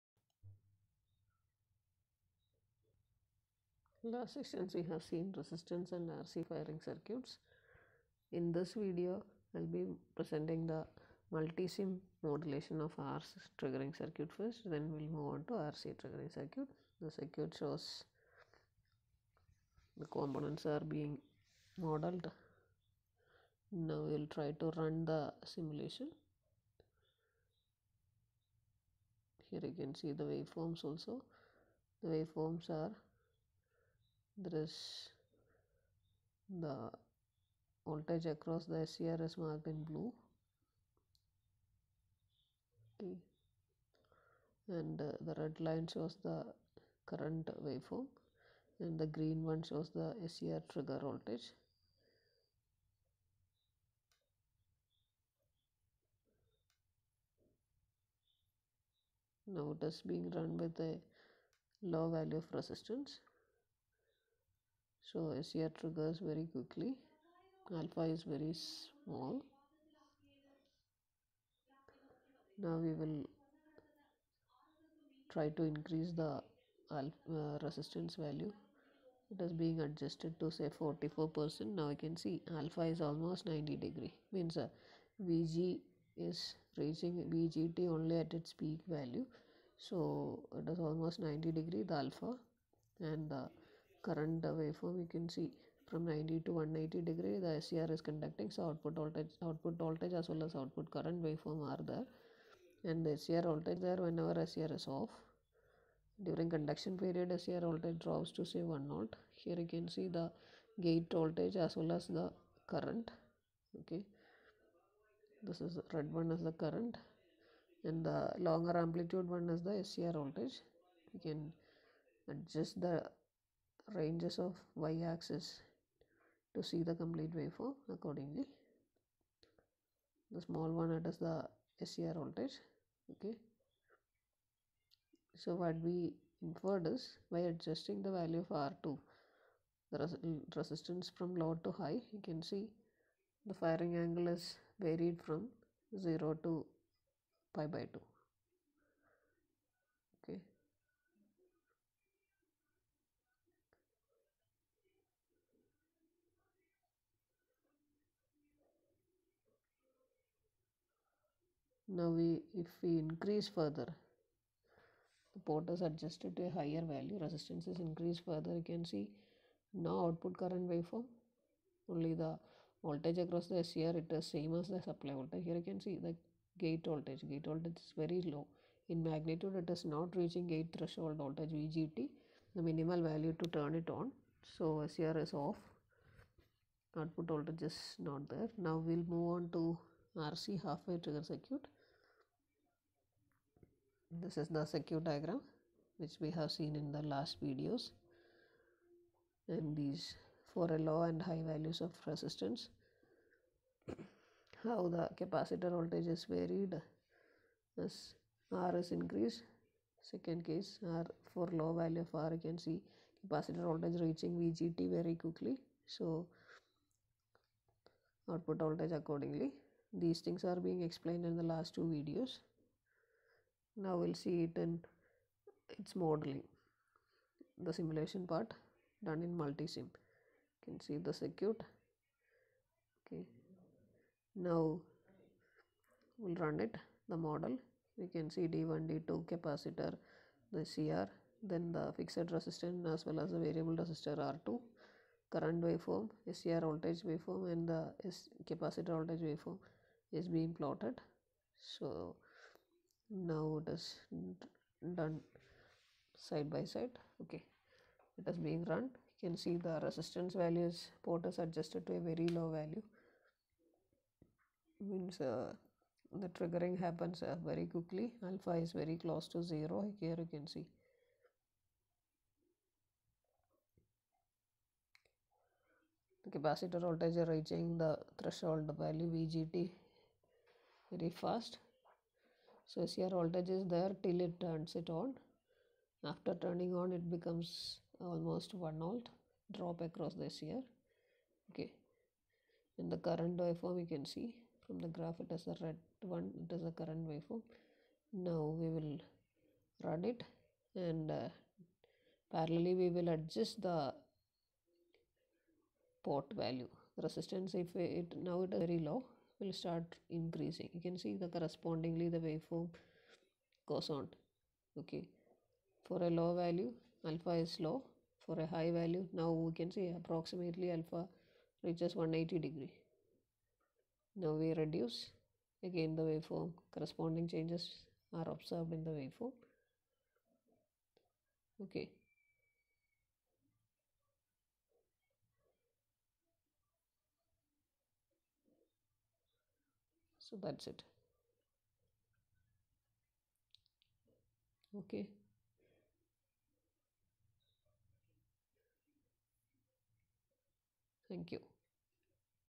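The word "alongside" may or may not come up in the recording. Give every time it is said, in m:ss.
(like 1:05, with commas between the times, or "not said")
not said.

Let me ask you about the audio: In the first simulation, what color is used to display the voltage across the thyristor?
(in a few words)
Blue.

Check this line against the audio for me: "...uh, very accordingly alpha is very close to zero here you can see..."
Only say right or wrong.
wrong.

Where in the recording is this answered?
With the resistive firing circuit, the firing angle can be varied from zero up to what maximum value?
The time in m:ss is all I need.
2:27.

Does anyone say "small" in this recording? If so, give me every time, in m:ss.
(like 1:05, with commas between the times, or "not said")
1:08, 2:10.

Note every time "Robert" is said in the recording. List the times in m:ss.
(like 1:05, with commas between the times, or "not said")
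not said.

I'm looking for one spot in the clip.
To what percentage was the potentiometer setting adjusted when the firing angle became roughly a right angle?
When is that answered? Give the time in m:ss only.
1:20.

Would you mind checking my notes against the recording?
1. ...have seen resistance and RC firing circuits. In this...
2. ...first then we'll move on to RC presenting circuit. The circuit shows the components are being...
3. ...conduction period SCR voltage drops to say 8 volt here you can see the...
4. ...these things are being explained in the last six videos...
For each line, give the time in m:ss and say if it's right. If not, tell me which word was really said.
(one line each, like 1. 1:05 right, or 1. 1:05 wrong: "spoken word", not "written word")
1. 0:04 right
2. 0:14 wrong: "triggering", not "presenting"
3. 1:46 wrong: "1", not "8"
4. 3:39 wrong: "two", not "six".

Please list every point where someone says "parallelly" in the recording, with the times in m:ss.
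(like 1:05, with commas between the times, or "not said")
5:02.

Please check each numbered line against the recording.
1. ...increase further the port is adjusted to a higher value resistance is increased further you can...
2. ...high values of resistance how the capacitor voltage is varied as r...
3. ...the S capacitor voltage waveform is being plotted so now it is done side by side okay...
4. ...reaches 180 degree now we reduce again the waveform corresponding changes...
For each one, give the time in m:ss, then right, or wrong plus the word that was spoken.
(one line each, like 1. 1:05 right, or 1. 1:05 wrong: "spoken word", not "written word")
1. 2:42 right
2. 3:21 right
3. 4:07 right
4. 5:21 right.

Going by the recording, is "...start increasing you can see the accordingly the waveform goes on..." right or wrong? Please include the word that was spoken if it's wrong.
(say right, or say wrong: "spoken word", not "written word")
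wrong: "correspondingly", not "accordingly".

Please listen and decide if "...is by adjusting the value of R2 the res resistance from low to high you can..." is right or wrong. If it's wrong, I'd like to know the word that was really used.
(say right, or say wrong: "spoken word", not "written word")
right.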